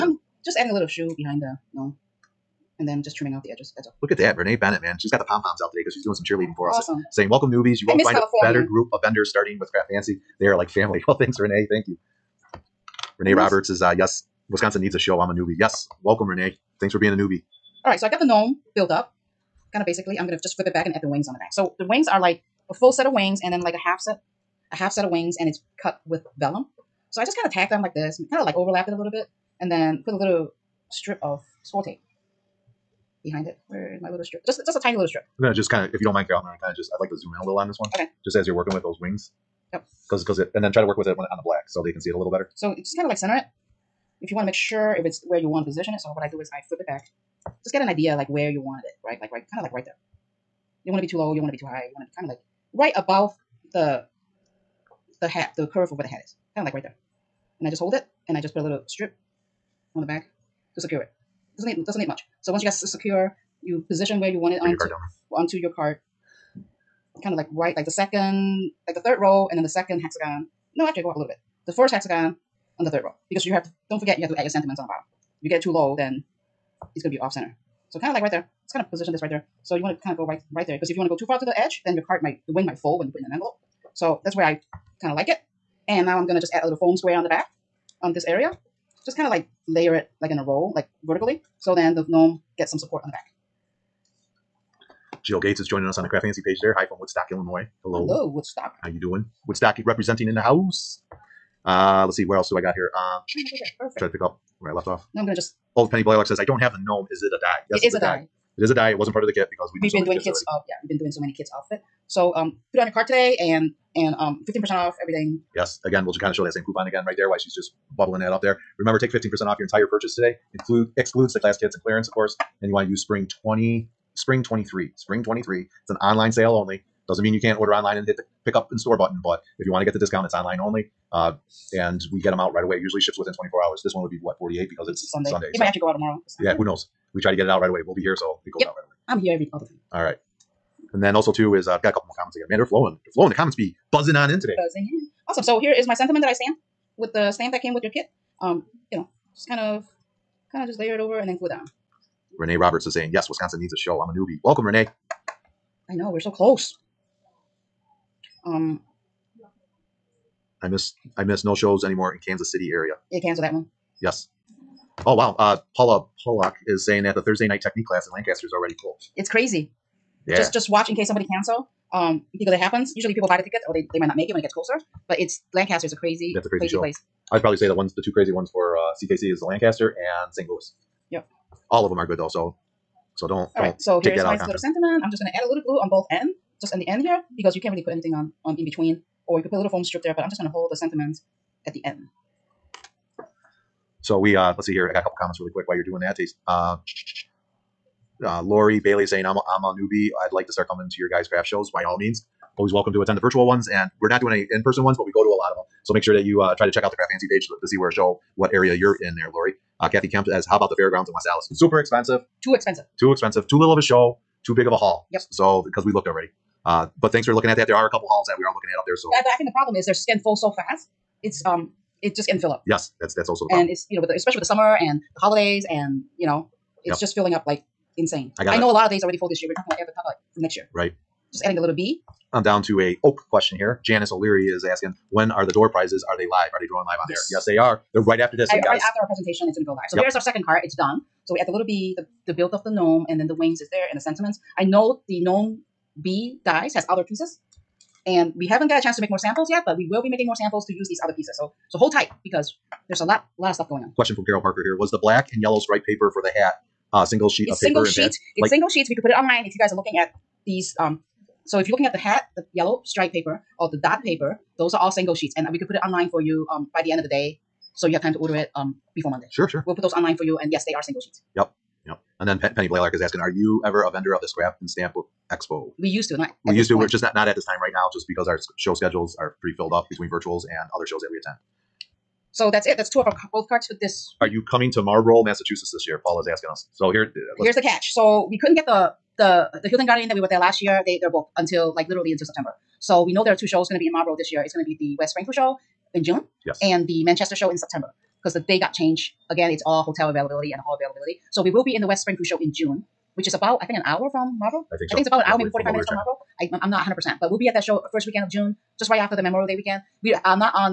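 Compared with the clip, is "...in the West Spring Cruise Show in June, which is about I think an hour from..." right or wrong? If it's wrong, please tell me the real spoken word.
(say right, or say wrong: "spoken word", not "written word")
right.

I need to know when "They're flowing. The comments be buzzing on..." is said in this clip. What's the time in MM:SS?
02:23.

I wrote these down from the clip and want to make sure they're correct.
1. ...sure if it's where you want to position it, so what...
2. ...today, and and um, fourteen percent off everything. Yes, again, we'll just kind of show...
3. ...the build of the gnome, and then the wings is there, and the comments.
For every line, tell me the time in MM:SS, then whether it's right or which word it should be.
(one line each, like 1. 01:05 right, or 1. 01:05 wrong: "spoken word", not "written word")
1. 00:44 right
2. 01:53 wrong: "fifteen", not "fourteen"
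3. 04:02 wrong: "sentiments", not "comments".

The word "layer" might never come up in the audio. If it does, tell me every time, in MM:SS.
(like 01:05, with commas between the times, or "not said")
01:29, 02:30.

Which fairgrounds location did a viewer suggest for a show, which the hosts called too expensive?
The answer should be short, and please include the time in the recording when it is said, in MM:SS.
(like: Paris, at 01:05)
West Allis, at 03:31.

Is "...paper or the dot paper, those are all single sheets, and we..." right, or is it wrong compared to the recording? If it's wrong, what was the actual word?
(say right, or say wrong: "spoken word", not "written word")
right.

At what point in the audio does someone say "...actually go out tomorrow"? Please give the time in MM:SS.
02:15.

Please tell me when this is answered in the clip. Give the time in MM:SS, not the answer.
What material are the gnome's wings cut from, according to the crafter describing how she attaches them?
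00:26.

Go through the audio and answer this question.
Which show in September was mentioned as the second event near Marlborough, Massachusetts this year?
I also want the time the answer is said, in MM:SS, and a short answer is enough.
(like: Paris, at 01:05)
Manchester, at 04:57.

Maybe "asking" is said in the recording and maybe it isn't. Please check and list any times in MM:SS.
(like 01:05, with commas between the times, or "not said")
03:54, 04:33, 04:46.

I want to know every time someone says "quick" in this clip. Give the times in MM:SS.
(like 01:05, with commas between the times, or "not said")
03:15.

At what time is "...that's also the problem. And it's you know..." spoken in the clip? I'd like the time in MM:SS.
03:43.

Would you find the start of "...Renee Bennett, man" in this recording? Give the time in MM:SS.
00:04.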